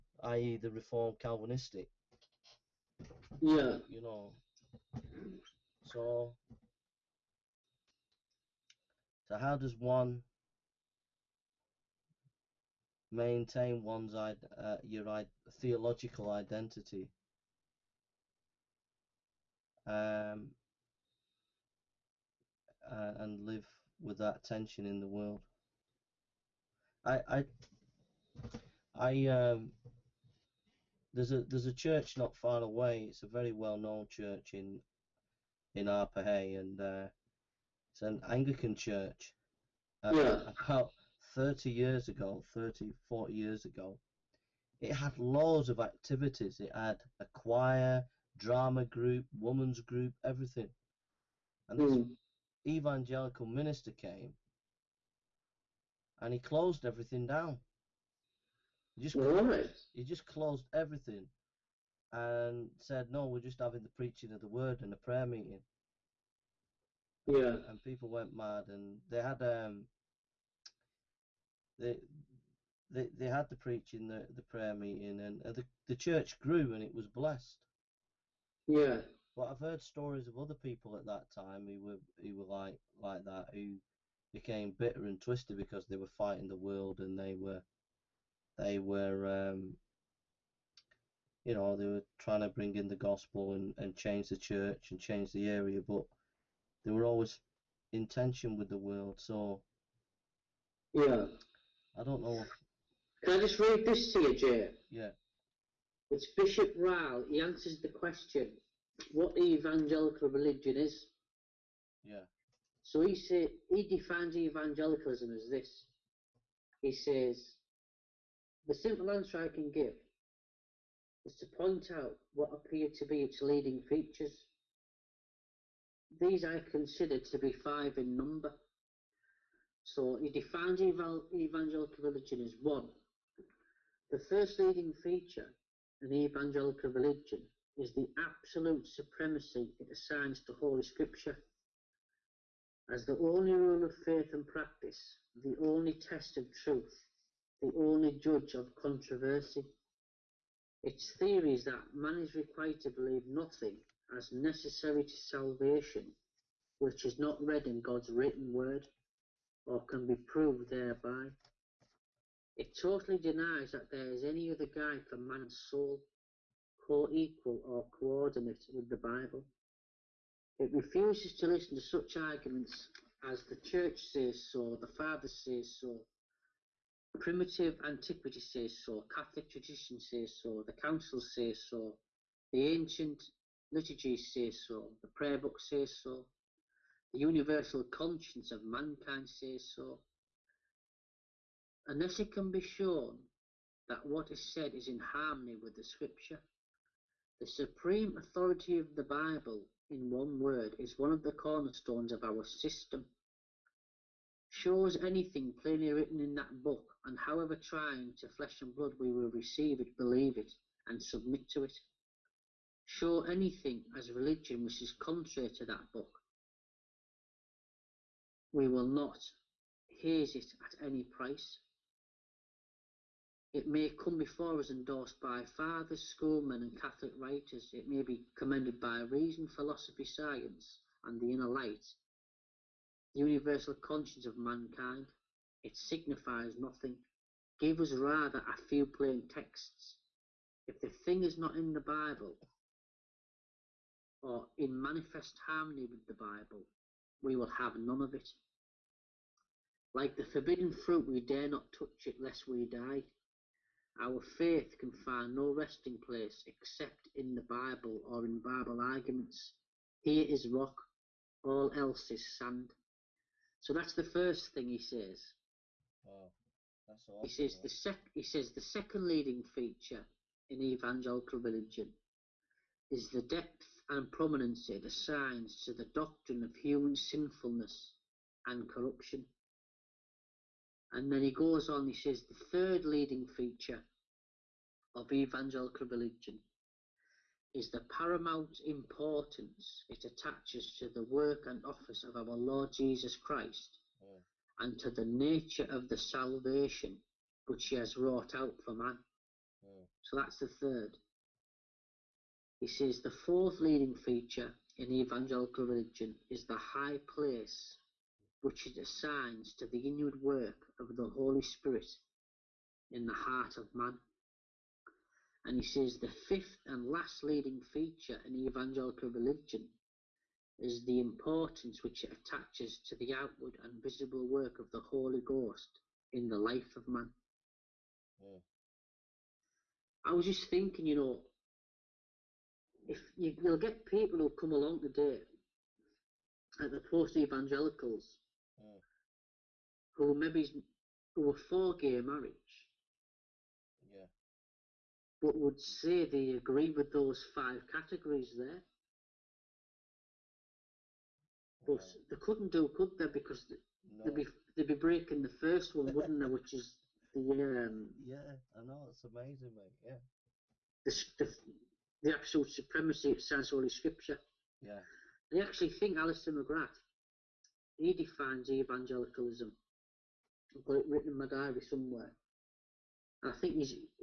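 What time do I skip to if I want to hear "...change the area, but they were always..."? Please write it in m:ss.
1:35.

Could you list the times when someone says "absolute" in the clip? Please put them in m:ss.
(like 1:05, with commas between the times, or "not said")
2:18, 6:02.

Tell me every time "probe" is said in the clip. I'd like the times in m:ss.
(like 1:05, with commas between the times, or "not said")
not said.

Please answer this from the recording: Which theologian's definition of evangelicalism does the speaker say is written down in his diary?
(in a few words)
Alister McGrath.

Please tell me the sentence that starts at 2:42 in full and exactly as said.
It totally denies that there is any other guide for man's soul, co-equal or coordinate with the Bible.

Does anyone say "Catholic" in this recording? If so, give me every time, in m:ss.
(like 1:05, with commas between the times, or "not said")
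2:59, 3:46.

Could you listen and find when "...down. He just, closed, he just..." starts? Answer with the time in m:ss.
0:57.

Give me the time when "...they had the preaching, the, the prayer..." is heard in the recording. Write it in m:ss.
1:13.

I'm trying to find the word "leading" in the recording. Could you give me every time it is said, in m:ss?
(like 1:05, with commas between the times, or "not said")
2:03, 2:14, 4:29, 4:42, 5:03, 5:17.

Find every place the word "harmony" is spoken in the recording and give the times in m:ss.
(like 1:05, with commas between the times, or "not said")
3:15, 4:05.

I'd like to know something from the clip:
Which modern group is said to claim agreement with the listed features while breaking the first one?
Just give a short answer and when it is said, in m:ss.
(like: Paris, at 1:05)
Post-evangelicals, at 5:36.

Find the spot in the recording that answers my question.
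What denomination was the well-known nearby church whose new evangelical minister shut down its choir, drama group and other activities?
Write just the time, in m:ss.
0:38.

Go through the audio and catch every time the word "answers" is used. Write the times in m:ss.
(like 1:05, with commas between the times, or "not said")
1:47, 1:59.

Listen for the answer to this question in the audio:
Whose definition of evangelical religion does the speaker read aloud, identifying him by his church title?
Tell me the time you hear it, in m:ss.
1:46.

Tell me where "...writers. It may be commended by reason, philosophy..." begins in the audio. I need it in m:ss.
3:47.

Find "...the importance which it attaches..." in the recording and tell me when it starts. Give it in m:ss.
5:20.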